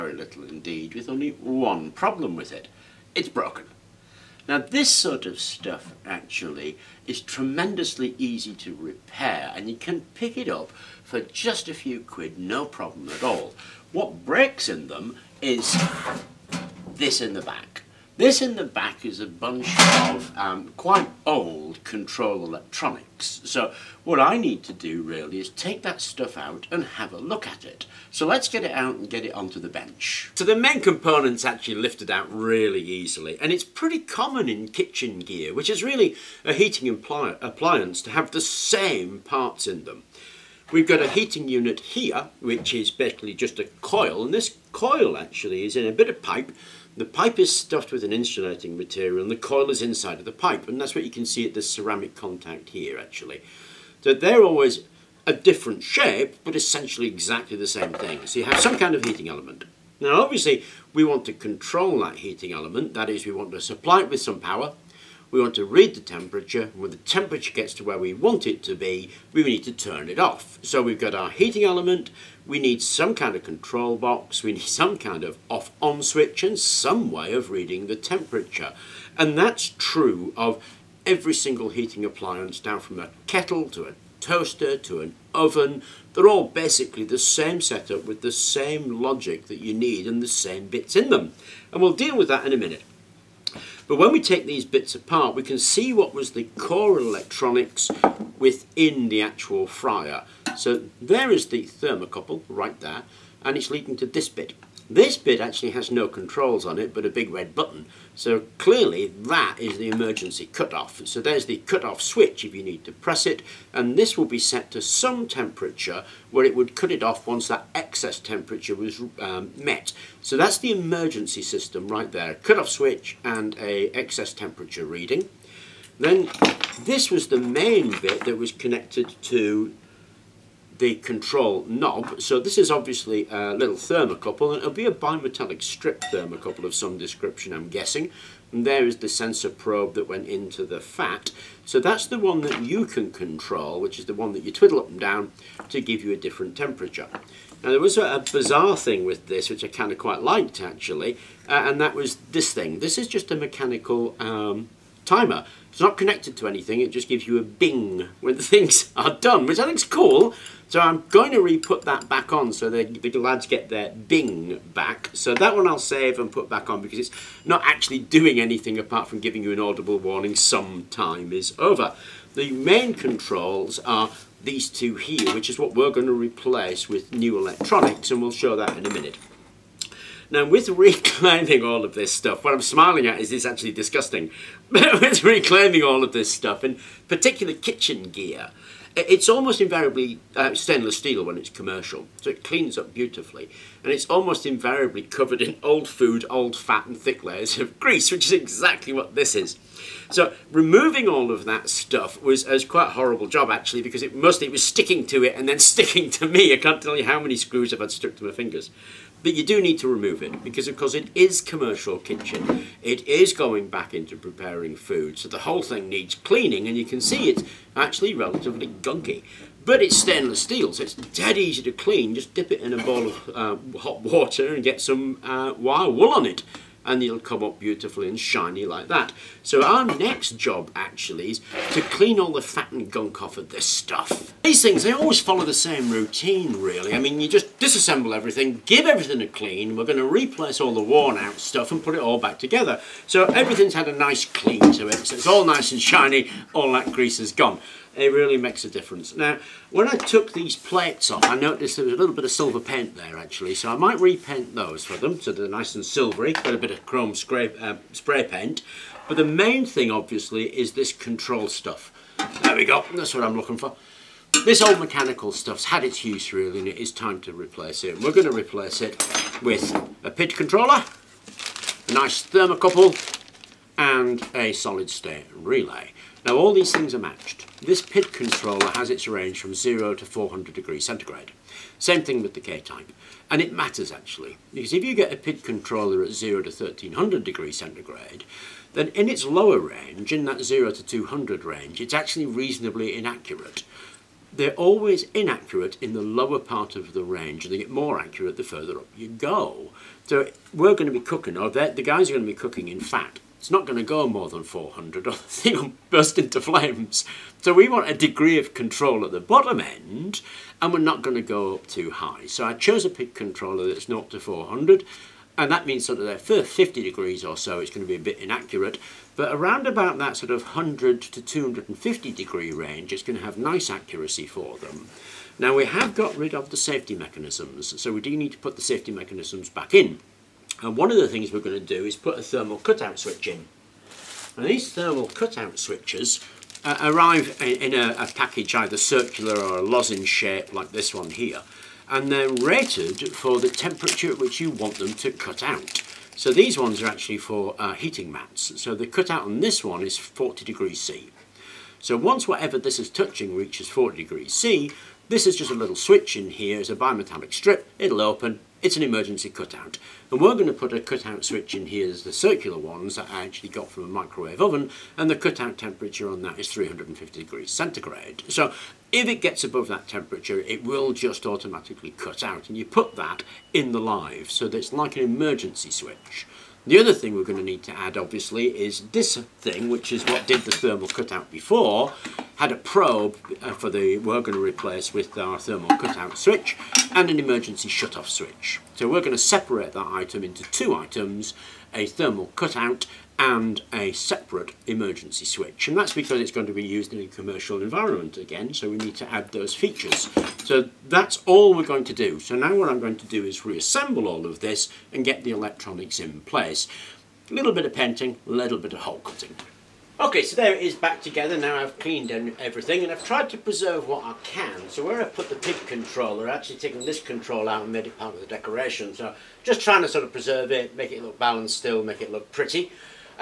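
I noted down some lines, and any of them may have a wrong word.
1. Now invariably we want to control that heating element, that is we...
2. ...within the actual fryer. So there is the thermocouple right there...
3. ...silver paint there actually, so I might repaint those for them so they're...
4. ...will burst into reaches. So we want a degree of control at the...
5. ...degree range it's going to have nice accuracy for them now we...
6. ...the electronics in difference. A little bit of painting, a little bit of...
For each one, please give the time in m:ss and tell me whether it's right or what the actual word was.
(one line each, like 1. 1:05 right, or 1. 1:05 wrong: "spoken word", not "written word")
1. 0:59 wrong: "obviously", not "invariably"
2. 1:38 right
3. 4:12 right
4. 5:05 wrong: "flames", not "reaches"
5. 5:22 right
6. 6:45 wrong: "place", not "difference".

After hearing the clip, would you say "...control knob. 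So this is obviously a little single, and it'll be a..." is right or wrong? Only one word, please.
wrong.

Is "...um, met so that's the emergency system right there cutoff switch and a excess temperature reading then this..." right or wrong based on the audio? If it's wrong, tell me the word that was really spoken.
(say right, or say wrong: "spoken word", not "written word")
right.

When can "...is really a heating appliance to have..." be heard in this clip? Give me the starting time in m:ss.
0:35.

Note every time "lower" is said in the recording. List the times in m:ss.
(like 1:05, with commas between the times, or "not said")
4:49, 4:56.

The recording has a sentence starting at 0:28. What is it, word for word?
So let's get it out and get it onto the bench.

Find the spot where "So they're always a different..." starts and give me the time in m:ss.
0:54.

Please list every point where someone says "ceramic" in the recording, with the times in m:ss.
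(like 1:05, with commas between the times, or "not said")
0:51.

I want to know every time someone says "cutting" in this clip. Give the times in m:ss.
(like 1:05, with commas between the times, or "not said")
6:48.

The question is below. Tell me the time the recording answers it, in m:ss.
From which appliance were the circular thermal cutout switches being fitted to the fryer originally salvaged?
6:03.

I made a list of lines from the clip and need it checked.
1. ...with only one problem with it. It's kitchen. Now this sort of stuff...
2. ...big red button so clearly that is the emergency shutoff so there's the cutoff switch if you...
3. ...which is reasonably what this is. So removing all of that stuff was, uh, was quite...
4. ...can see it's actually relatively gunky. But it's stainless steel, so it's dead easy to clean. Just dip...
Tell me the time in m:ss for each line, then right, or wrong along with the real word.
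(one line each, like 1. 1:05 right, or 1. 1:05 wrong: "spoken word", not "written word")
1. 0:00 wrong: "broken", not "kitchen"
2. 1:47 wrong: "cutoff", not "shutoff"
3. 3:18 wrong: "exactly", not "reasonably"
4. 3:36 right.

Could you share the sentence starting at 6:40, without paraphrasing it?
So that's all we're going to do.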